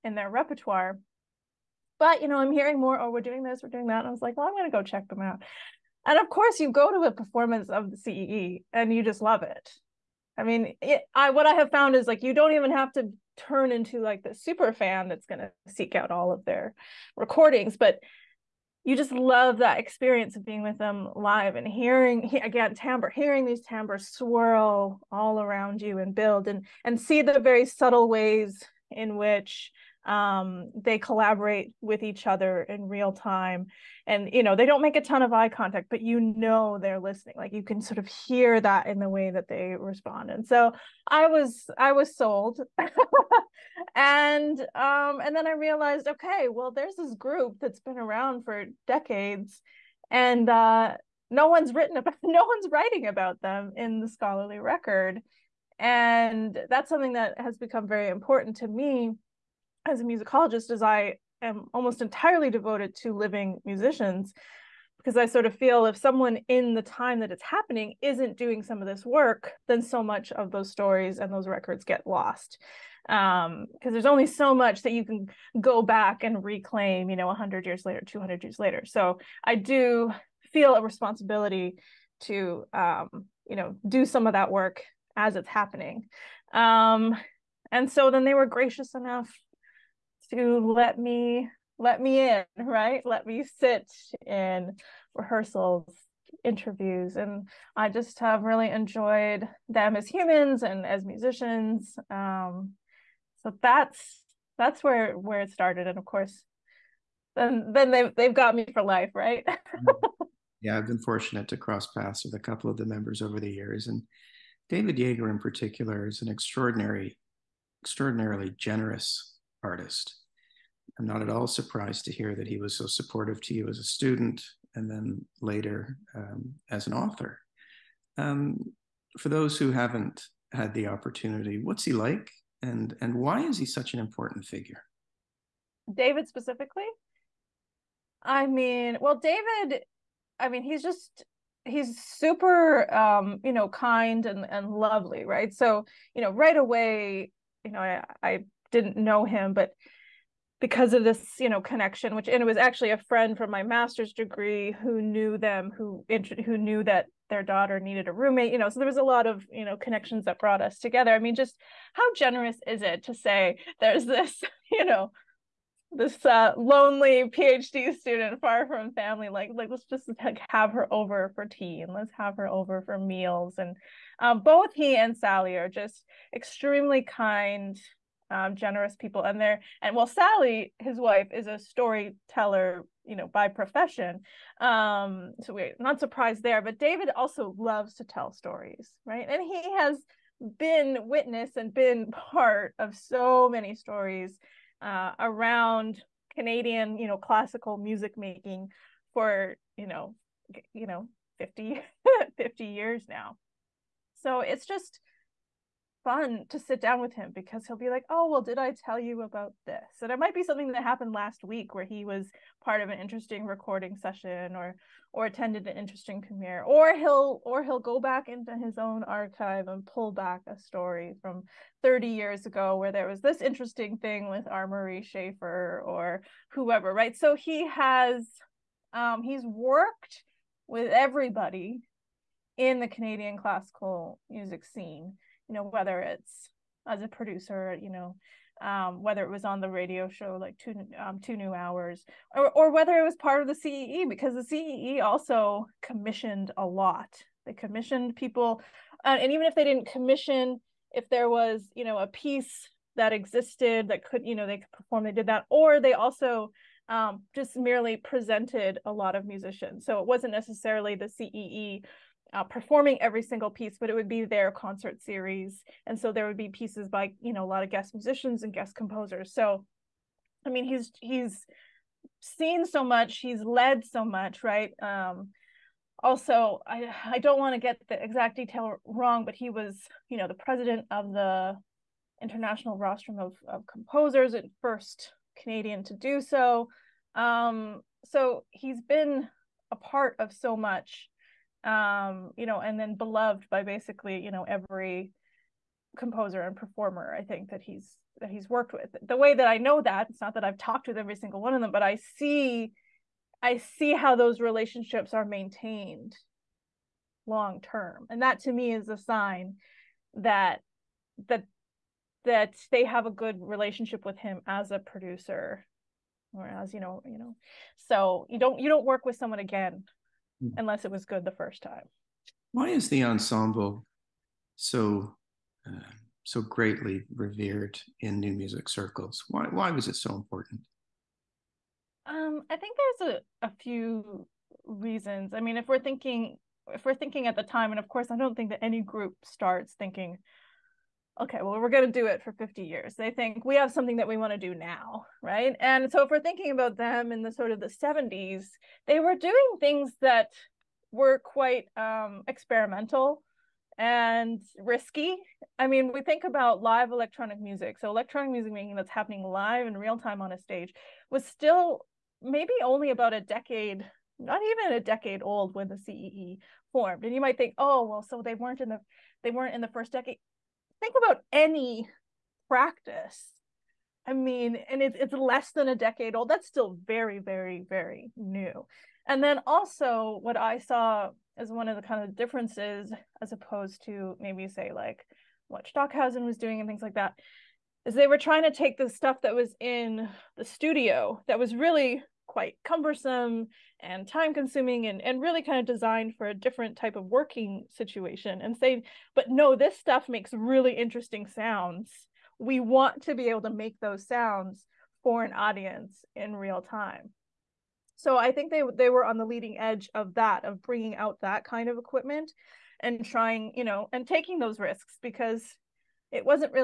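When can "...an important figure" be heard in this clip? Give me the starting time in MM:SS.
02:13.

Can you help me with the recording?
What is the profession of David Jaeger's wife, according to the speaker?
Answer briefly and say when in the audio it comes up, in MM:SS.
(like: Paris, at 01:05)
Storyteller, at 03:01.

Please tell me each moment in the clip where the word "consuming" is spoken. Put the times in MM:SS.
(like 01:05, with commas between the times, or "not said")
06:34.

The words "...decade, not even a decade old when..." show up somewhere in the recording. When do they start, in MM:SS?
06:03.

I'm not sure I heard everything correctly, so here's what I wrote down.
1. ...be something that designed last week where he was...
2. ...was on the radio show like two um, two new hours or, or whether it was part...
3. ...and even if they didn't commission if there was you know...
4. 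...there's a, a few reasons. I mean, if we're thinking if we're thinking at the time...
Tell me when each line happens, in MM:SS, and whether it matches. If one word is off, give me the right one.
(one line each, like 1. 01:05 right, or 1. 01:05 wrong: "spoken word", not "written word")
1. 03:30 wrong: "happened", not "designed"
2. 03:59 right
3. 04:09 right
4. 05:32 right.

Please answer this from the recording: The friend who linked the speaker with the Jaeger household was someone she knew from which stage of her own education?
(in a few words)
master's degree.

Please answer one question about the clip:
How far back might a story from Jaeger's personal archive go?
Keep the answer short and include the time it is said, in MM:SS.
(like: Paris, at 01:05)
30 years ago, at 03:41.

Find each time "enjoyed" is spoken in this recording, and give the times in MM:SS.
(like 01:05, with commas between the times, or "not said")
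01:38.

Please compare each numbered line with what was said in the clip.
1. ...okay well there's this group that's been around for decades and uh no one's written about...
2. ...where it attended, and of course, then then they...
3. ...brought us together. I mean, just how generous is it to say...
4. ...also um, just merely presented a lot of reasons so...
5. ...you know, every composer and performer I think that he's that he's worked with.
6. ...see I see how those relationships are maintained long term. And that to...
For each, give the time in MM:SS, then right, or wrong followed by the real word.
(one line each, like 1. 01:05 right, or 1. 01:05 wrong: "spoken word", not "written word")
1. 00:46 right
2. 01:45 wrong: "started", not "attended"
3. 02:40 right
4. 04:15 wrong: "musicians", not "reasons"
5. 04:54 right
6. 05:02 right.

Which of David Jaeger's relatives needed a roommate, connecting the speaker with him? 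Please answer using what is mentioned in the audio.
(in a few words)
Their daughter.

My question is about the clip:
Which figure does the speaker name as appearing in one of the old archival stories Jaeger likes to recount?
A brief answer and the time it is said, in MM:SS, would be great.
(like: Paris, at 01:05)
R. Murray Schafer, at 03:44.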